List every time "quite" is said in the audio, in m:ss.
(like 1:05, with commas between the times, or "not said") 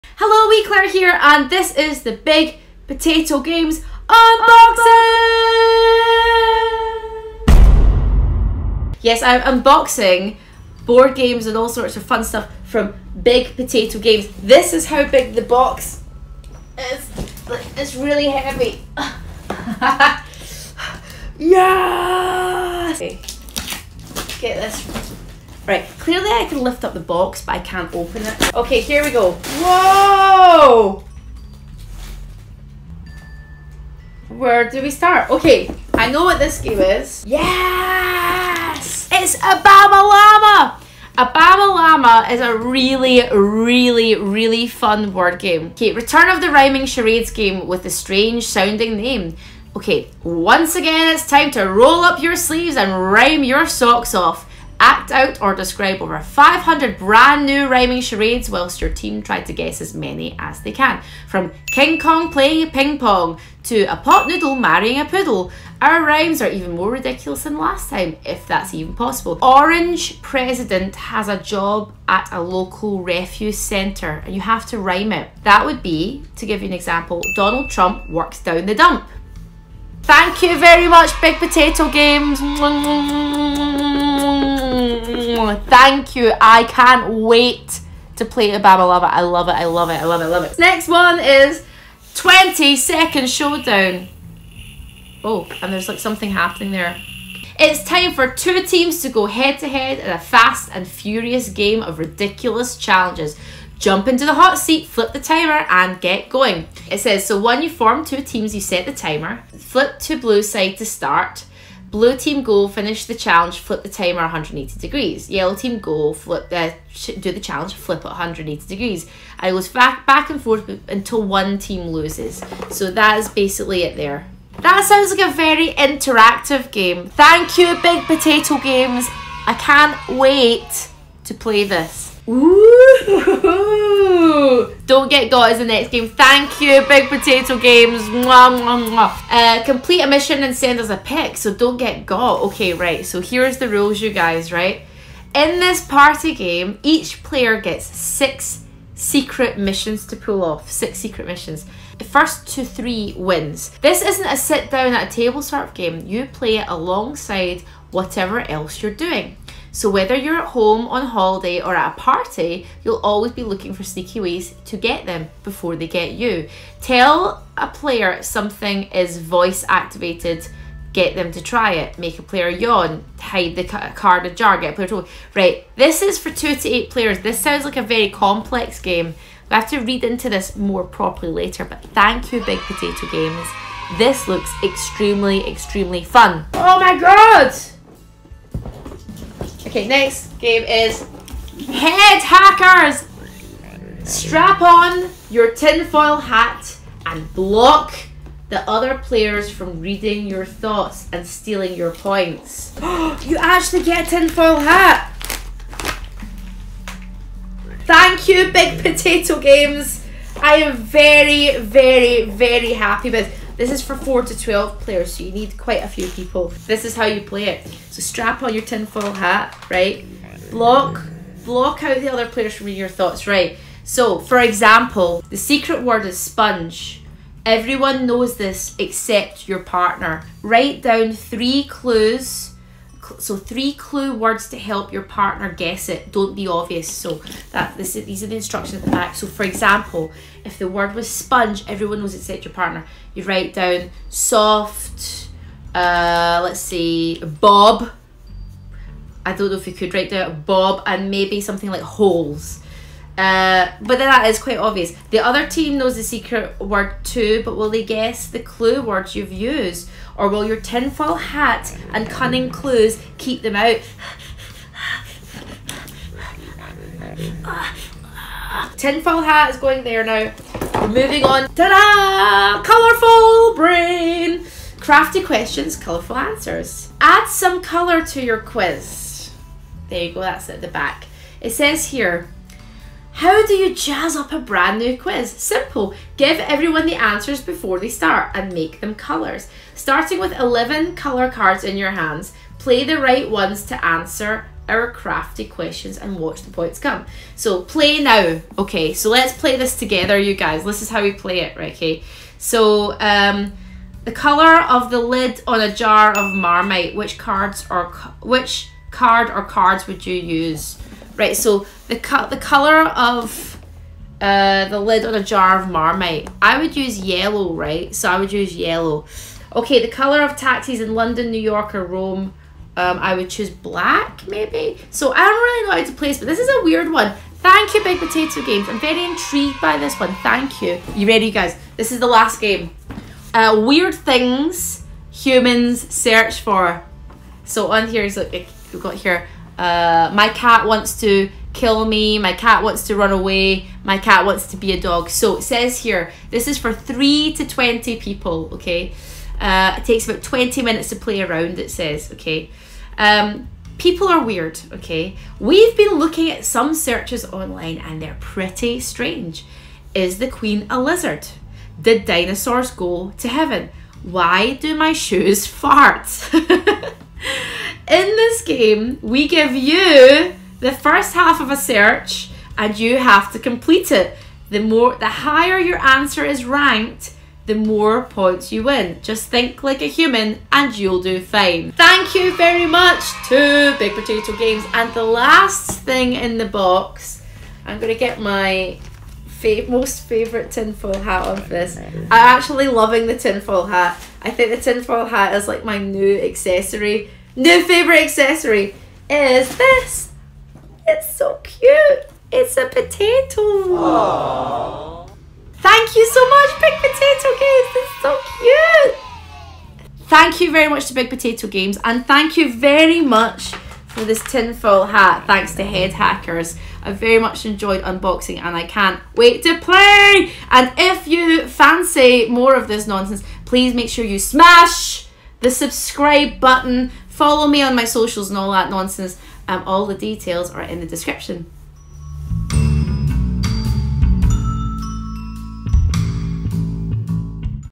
3:35, 4:14.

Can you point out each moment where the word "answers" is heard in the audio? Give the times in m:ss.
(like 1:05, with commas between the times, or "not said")
4:36, 4:46, 4:53, 6:15.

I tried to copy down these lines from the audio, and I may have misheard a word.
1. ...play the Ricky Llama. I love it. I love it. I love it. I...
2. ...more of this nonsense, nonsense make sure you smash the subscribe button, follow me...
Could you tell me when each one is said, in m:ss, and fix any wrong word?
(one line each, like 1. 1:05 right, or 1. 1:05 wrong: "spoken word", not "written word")
1. 1:28 wrong: "Obama", not "Ricky"
2. 7:02 wrong: "please", not "nonsense".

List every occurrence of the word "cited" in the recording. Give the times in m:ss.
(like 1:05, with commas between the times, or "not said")
not said.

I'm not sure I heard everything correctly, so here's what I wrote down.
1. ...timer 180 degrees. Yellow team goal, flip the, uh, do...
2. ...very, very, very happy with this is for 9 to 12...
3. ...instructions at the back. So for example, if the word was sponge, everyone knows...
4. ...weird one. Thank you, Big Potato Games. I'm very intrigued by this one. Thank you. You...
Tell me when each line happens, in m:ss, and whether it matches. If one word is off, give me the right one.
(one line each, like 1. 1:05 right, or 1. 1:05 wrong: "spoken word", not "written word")
1. 1:53 right
2. 3:30 wrong: "4", not "9"
3. 3:58 right
4. 5:26 right.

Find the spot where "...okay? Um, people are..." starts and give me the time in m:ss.
5:52.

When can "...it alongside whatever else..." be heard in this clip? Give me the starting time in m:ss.
2:36.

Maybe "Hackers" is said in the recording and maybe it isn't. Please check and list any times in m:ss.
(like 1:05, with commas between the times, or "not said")
3:12, 6:55.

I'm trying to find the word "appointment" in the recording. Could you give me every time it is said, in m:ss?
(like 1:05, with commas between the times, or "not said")
not said.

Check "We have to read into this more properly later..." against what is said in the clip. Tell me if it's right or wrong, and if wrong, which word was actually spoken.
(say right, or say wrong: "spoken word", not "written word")
right.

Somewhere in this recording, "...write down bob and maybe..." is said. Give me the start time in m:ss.
4:09.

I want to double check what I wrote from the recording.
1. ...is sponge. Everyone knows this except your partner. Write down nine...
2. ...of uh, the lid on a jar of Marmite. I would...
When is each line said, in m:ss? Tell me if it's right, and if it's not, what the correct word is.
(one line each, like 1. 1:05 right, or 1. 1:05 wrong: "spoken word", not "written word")
1. 3:46 wrong: "three", not "nine"
2. 5:12 right.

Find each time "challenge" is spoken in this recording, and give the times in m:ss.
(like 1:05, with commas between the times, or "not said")
1:42, 1:53, 1:57.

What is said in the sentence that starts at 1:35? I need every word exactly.
Oh, and there's like something happening there.